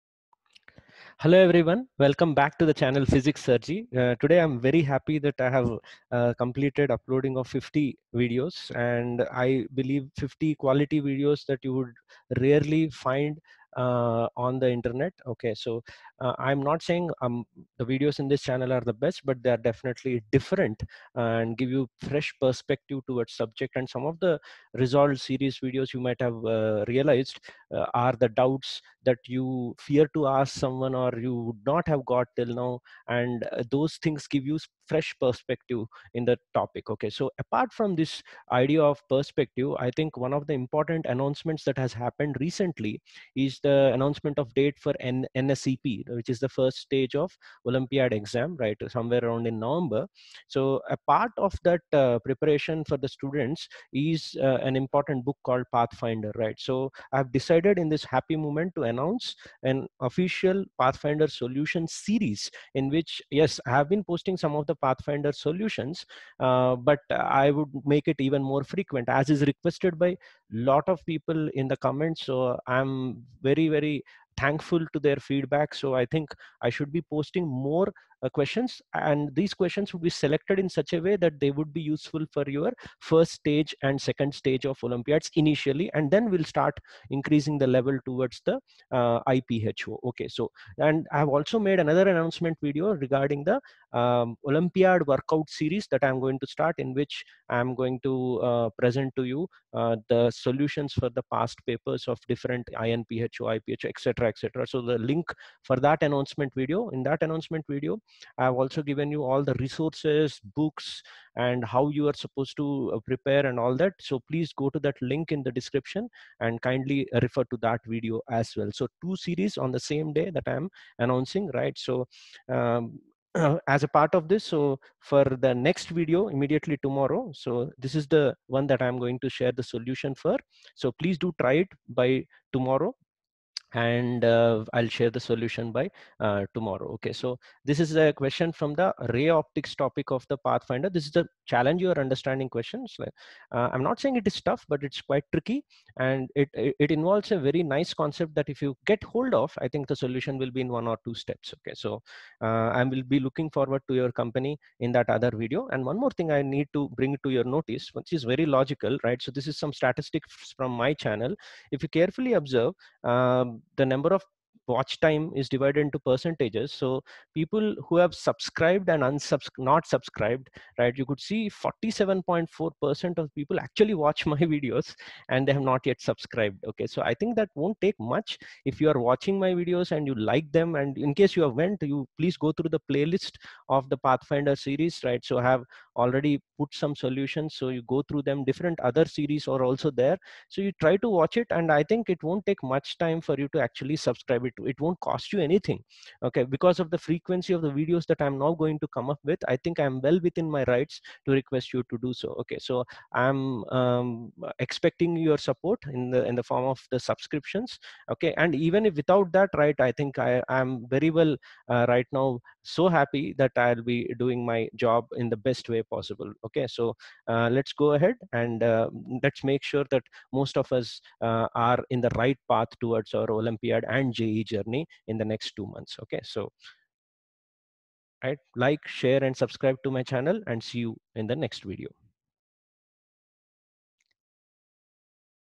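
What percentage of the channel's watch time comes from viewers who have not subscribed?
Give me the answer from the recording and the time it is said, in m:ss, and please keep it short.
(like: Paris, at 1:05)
47.4%, at 2:51.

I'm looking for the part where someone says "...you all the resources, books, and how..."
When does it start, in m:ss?
1:49.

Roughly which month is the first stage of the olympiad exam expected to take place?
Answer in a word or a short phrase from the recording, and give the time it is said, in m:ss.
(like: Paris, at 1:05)
November, at 0:49.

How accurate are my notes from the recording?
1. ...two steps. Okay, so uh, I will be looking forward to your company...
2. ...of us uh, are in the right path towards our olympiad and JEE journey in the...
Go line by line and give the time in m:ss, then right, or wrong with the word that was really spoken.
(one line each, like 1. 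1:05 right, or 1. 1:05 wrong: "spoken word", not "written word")
1. 2:31 right
2. 3:40 right.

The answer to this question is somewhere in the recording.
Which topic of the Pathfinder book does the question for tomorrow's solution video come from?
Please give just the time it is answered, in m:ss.
2:19.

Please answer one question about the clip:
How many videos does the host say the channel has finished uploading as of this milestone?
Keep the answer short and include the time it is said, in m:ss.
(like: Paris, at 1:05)
50, at 0:07.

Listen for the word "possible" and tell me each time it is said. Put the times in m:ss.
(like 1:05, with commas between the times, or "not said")
3:35.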